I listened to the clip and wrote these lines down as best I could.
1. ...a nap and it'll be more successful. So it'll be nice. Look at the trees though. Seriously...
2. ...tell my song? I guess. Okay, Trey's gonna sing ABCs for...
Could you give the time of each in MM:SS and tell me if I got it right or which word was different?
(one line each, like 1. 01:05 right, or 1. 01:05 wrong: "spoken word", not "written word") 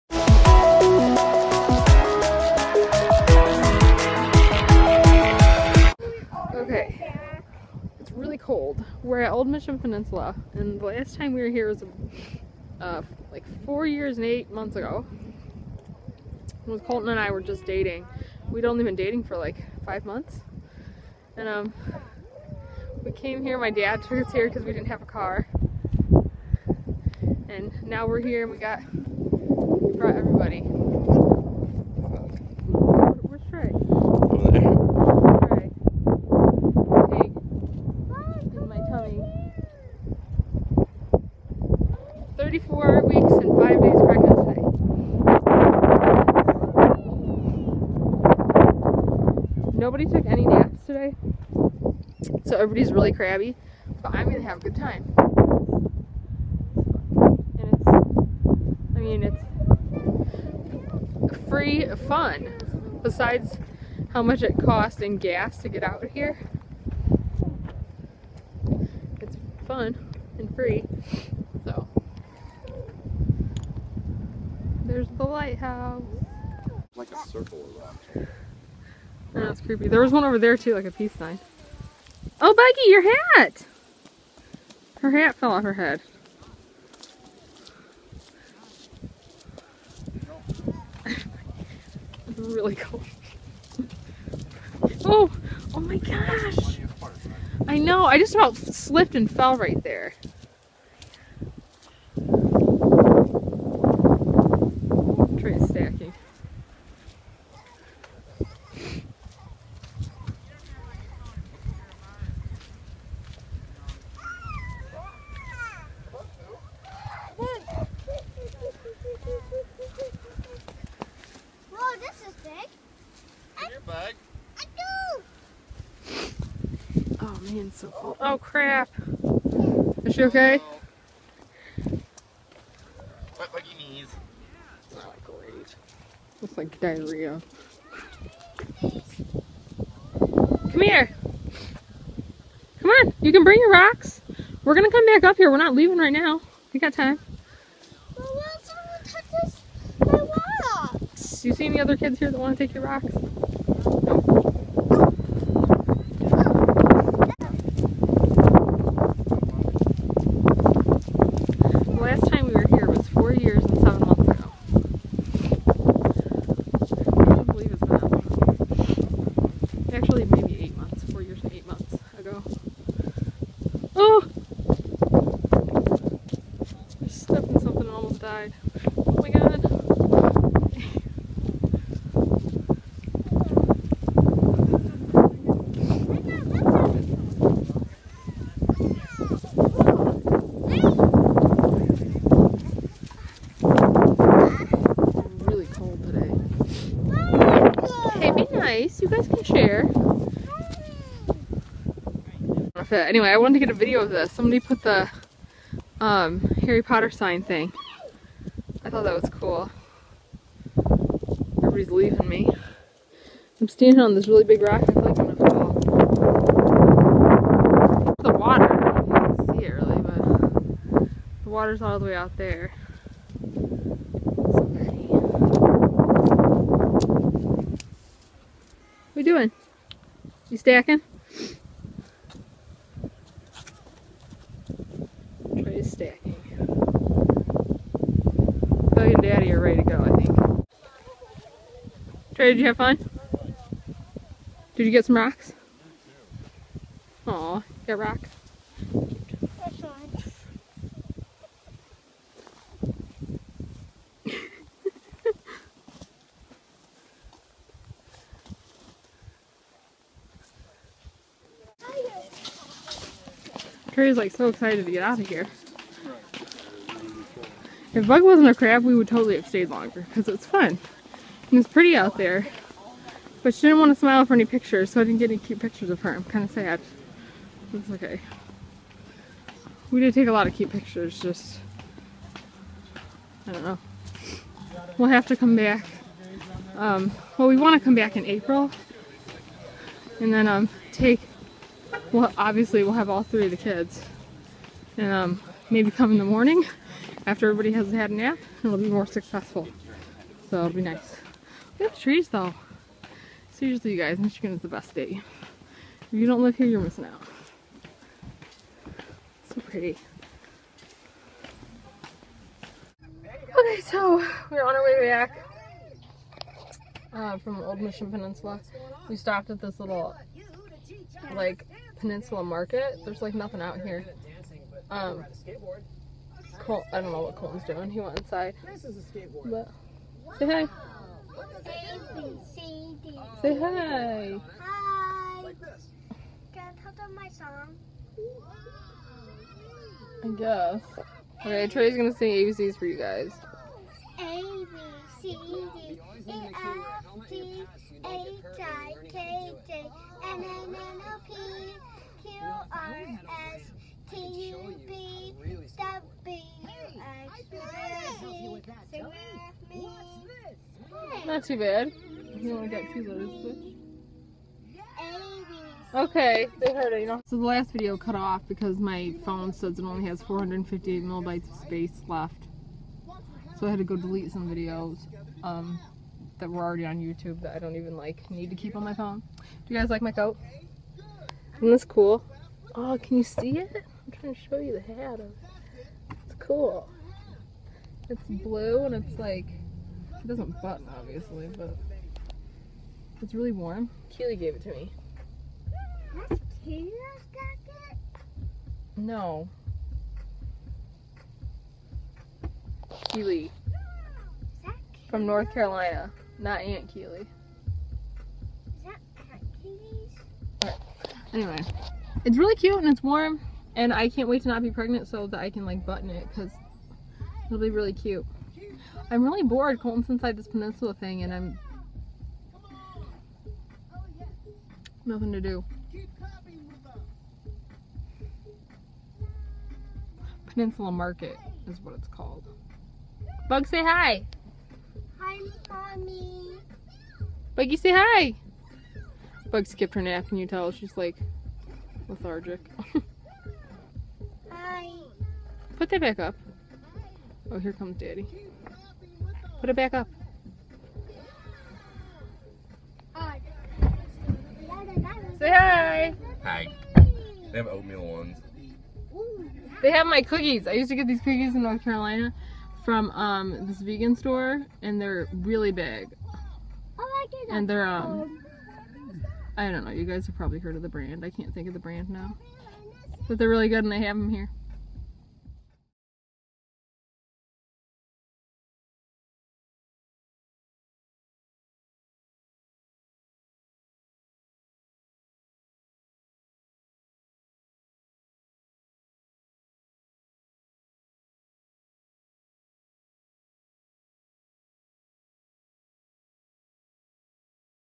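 1. 04:58 right
2. 05:36 right.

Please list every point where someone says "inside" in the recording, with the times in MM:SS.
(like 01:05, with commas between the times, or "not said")
05:28, 07:00.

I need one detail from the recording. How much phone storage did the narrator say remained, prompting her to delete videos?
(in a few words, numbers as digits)
458 megabytes.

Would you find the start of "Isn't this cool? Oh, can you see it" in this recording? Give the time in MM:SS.
06:21.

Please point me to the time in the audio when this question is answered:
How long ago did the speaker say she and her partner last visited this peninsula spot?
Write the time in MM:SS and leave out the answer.
00:13.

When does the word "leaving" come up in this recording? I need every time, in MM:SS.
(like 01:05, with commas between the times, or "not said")
02:25, 03:31.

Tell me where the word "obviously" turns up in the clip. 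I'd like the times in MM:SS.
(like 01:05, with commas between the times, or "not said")
04:52, 06:30.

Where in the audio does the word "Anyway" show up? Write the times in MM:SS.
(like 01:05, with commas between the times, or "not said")
03:23, 06:51.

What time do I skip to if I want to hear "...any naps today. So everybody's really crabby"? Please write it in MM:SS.
00:50.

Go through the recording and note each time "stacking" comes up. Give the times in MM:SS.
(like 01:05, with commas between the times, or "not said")
03:50, 03:56.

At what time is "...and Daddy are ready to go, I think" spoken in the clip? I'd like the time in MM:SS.
03:59.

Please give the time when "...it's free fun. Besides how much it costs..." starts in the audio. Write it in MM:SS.
01:01.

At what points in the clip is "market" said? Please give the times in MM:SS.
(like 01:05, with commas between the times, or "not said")
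05:22, 07:10.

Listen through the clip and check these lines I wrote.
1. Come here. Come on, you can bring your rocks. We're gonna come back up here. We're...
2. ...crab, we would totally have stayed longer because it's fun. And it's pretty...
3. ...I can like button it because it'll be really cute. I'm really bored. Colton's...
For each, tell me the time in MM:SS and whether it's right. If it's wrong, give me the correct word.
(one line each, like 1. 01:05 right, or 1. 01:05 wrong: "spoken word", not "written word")
1. 02:18 right
2. 04:28 right
3. 06:55 right.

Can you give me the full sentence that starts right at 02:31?
Do you see any other kids here that want to take your rocks?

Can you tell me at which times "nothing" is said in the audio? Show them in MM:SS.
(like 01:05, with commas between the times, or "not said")
05:23, 07:05.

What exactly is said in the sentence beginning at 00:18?
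We'd only been dating for like five months.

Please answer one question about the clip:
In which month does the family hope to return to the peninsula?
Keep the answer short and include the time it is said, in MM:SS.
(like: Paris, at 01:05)
April, at 04:48.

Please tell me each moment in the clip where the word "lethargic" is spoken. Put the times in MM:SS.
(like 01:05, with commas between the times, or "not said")
07:22.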